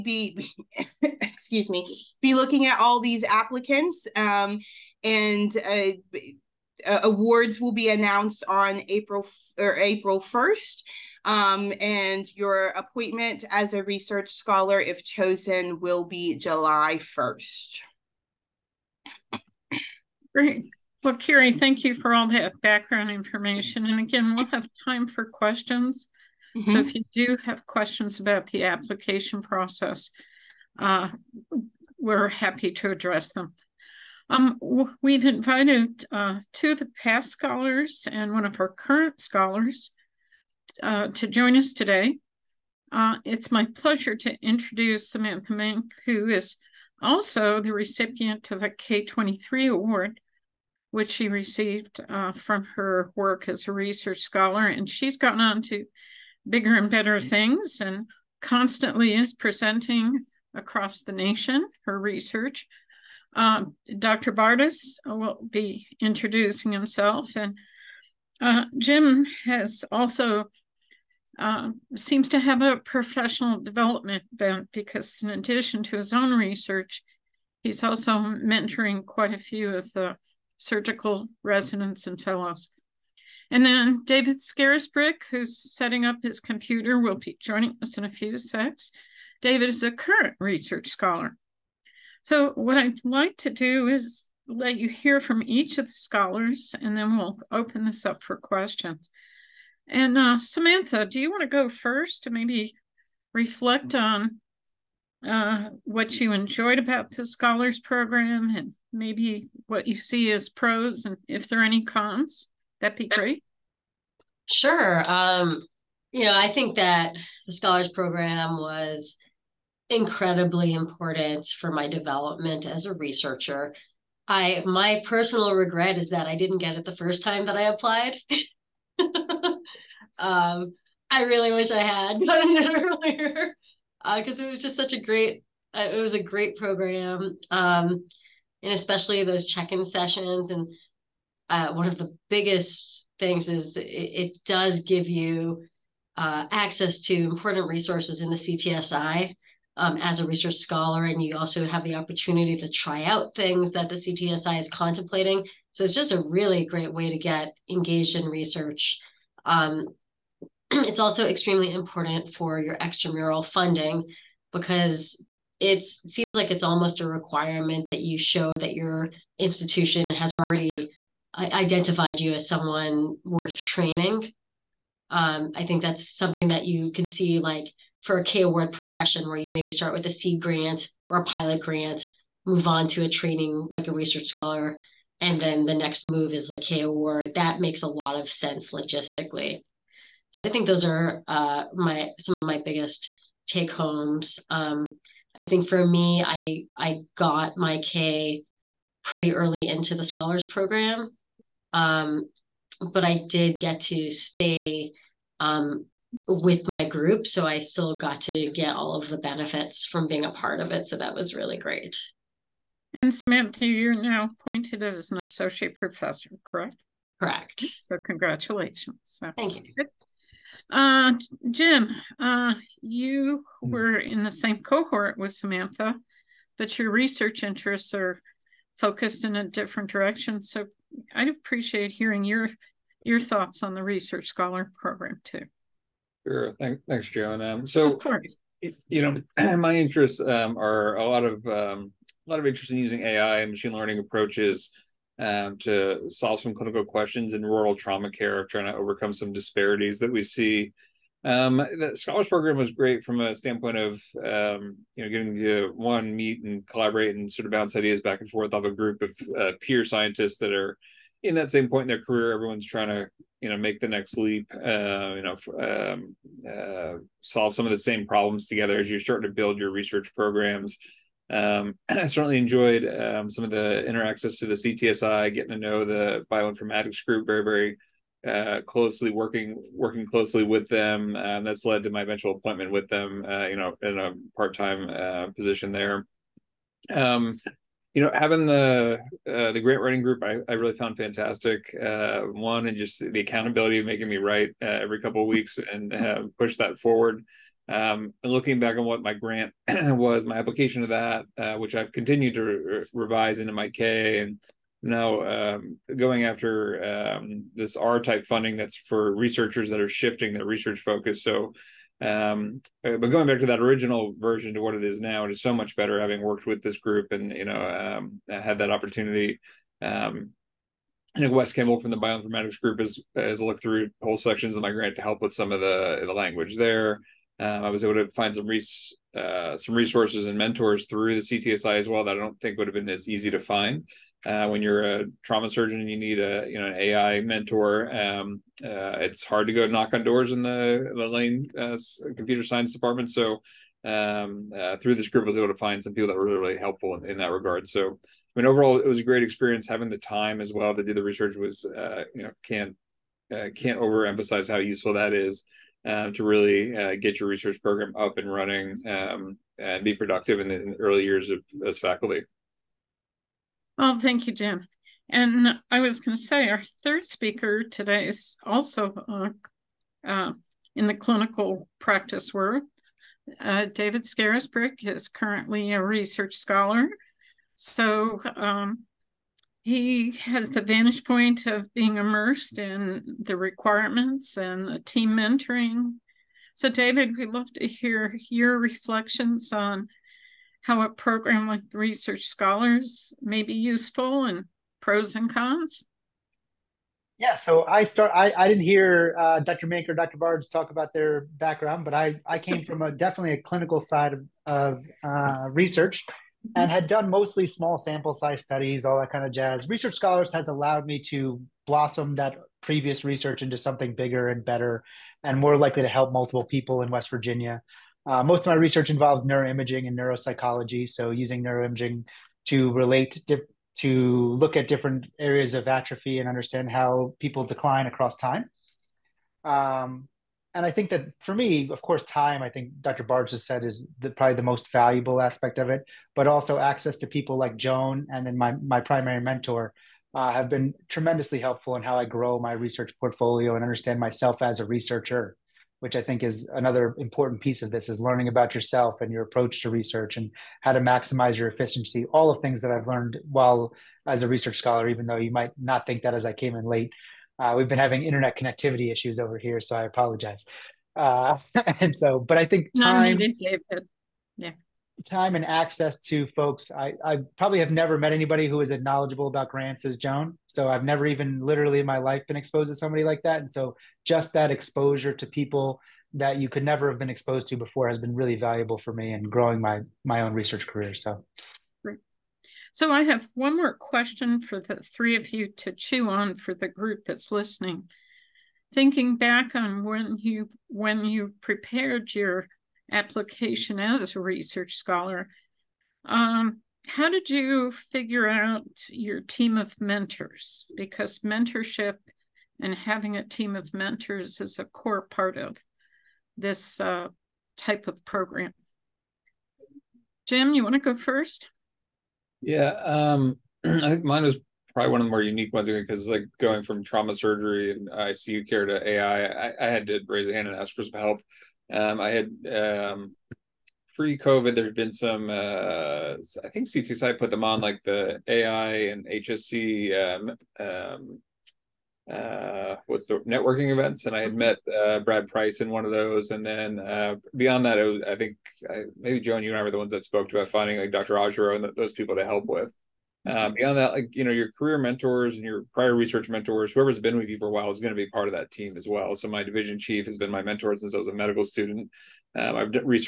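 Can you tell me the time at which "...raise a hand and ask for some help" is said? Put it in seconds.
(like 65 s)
520 s.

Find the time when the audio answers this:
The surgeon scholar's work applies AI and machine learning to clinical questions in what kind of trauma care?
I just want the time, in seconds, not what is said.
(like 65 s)
247 s.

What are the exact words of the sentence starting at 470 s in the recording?
So I've never even literally in my life been exposed to somebody like that.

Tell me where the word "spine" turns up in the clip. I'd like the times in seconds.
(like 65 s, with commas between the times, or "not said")
not said.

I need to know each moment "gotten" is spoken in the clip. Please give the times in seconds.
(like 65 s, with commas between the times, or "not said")
55 s, 132 s.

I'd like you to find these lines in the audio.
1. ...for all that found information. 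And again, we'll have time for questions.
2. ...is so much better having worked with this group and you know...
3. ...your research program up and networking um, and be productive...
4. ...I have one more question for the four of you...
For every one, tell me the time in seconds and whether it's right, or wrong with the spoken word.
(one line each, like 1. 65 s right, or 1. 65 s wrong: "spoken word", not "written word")
1. 21 s wrong: "background", not "found"
2. 315 s right
3. 357 s wrong: "running", not "networking"
4. 482 s wrong: "three", not "four".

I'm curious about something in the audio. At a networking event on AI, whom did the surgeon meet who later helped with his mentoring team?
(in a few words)
Brad Price.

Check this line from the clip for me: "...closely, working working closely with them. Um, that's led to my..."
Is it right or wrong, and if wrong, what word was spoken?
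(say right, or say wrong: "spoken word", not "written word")
right.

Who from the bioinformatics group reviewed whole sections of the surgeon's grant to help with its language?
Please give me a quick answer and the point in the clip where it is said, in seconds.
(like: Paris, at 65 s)
Wes Kimball, at 321 s.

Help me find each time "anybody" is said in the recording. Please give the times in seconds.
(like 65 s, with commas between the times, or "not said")
468 s.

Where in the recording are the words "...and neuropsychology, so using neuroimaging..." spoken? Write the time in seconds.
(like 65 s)
419 s.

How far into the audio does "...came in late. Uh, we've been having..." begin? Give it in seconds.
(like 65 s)
456 s.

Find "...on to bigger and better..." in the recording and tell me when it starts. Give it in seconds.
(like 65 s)
55 s.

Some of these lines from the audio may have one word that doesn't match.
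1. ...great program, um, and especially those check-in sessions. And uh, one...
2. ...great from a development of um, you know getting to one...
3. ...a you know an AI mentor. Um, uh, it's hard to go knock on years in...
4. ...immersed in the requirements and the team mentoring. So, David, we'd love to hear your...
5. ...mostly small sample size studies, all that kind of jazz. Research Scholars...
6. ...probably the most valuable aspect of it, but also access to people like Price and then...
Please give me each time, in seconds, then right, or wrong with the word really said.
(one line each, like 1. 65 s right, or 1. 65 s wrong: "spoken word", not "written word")
1. 136 s right
2. 252 s wrong: "standpoint", not "development"
3. 336 s wrong: "doors", not "years"
4. 381 s right
5. 407 s right
6. 434 s wrong: "Joan", not "Price".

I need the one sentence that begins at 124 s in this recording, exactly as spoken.
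I my personal regret is that I didn't get it the first time that I applied.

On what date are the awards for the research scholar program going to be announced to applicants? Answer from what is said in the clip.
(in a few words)
April 1st.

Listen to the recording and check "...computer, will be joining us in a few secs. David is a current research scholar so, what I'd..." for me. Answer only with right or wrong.
right.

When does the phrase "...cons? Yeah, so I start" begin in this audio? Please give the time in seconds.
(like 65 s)
395 s.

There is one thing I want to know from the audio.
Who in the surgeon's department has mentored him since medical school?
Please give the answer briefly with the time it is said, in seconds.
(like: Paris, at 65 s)
division chief, at 549 s.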